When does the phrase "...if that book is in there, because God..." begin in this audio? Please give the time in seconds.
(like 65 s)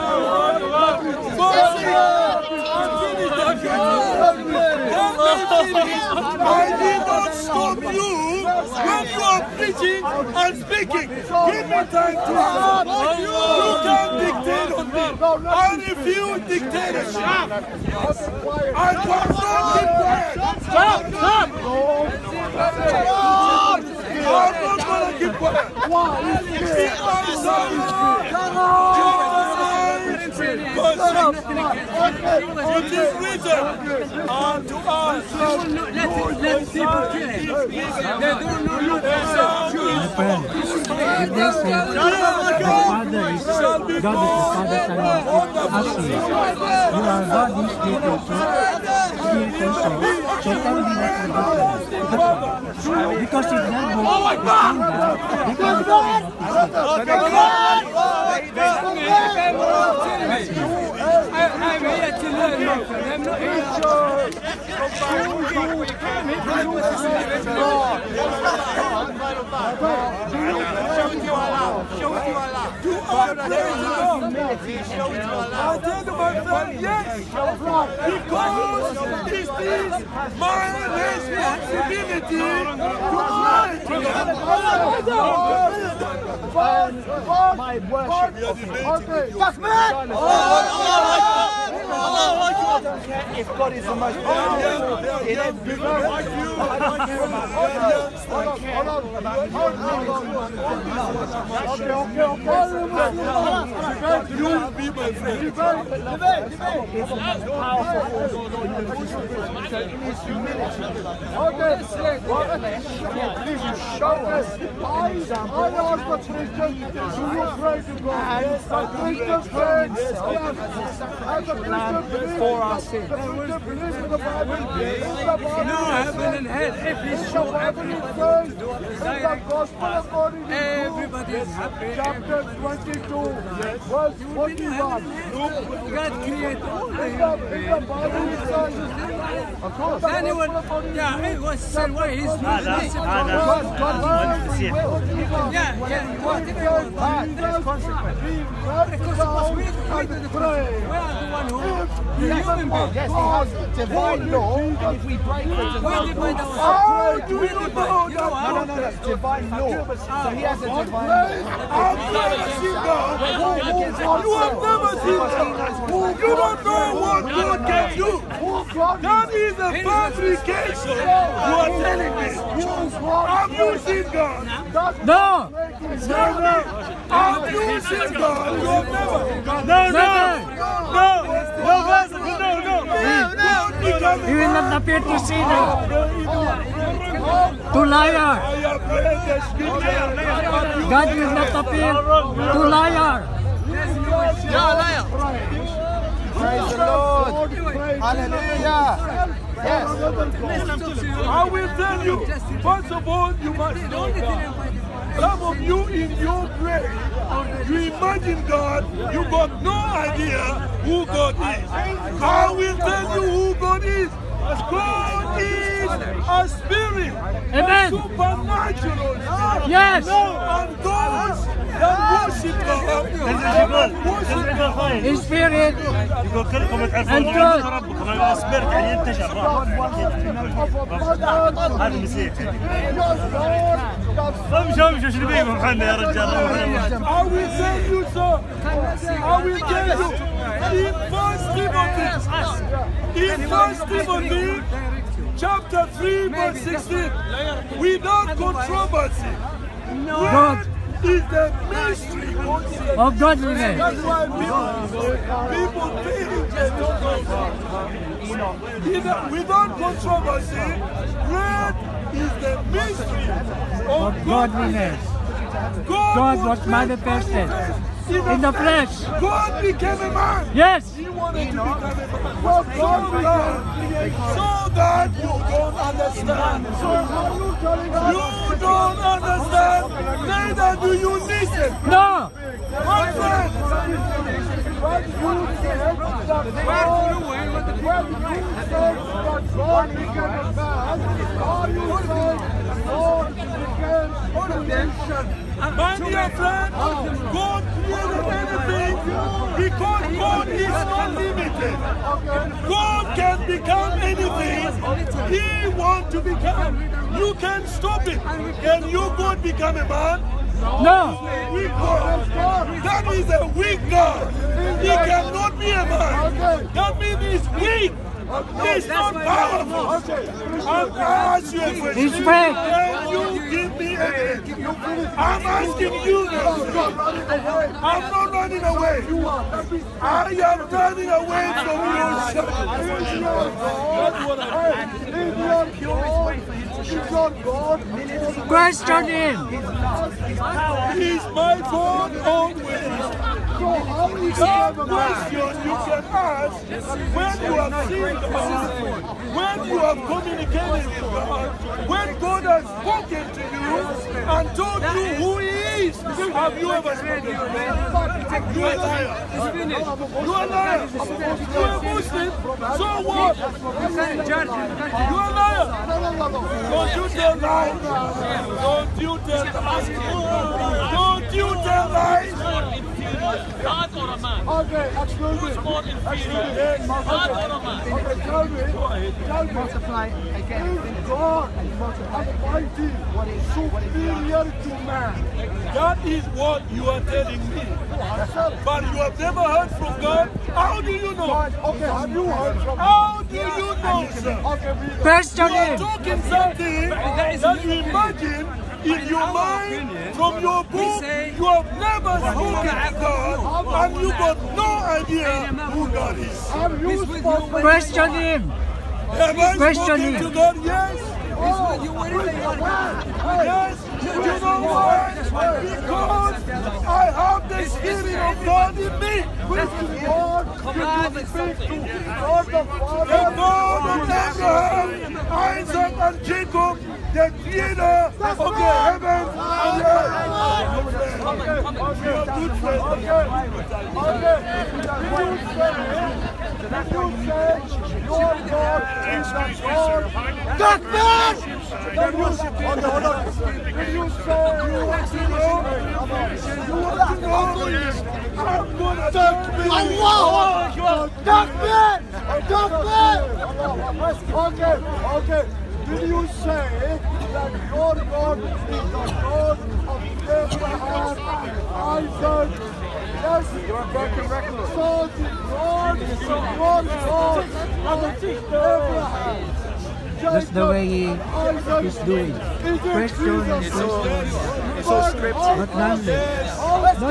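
53 s.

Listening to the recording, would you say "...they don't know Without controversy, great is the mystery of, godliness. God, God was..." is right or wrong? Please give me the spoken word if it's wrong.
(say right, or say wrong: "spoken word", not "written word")
right.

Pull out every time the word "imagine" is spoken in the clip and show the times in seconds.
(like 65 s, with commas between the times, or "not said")
207 s, 397 s.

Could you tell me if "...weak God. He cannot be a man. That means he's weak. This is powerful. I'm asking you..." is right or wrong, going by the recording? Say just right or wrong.
right.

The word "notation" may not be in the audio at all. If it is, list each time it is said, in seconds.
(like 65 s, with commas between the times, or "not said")
not said.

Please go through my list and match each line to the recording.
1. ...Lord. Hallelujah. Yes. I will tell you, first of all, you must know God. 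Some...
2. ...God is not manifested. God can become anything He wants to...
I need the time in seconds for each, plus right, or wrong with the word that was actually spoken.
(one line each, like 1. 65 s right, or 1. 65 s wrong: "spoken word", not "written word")
1. 196 s right
2. 300 s wrong: "limited", not "manifested".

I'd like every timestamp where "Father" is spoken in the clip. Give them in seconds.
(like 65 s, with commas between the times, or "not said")
46 s, 422 s.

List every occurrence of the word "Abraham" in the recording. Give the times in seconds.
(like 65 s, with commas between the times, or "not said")
424 s, 460 s, 468 s.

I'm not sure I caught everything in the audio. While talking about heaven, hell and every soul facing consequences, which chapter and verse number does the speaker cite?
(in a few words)
Chapter 22, verse 41.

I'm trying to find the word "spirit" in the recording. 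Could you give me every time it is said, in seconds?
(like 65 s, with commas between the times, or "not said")
216 s, 417 s.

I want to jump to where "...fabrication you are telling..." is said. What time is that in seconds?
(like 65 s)
169 s.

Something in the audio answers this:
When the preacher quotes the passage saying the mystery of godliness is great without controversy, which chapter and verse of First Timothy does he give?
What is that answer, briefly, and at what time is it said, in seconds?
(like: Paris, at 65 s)
Chapter 3 verse 16, at 245 s.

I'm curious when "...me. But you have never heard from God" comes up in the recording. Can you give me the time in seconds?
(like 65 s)
387 s.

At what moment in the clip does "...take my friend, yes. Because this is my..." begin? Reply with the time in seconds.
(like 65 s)
75 s.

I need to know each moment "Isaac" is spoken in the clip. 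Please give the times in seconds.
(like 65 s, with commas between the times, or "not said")
425 s, 461 s.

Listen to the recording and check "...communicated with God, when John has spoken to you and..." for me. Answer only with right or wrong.
wrong.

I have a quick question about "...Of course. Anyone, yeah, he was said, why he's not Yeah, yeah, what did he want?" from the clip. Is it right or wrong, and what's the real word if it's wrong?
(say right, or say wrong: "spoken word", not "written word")
right.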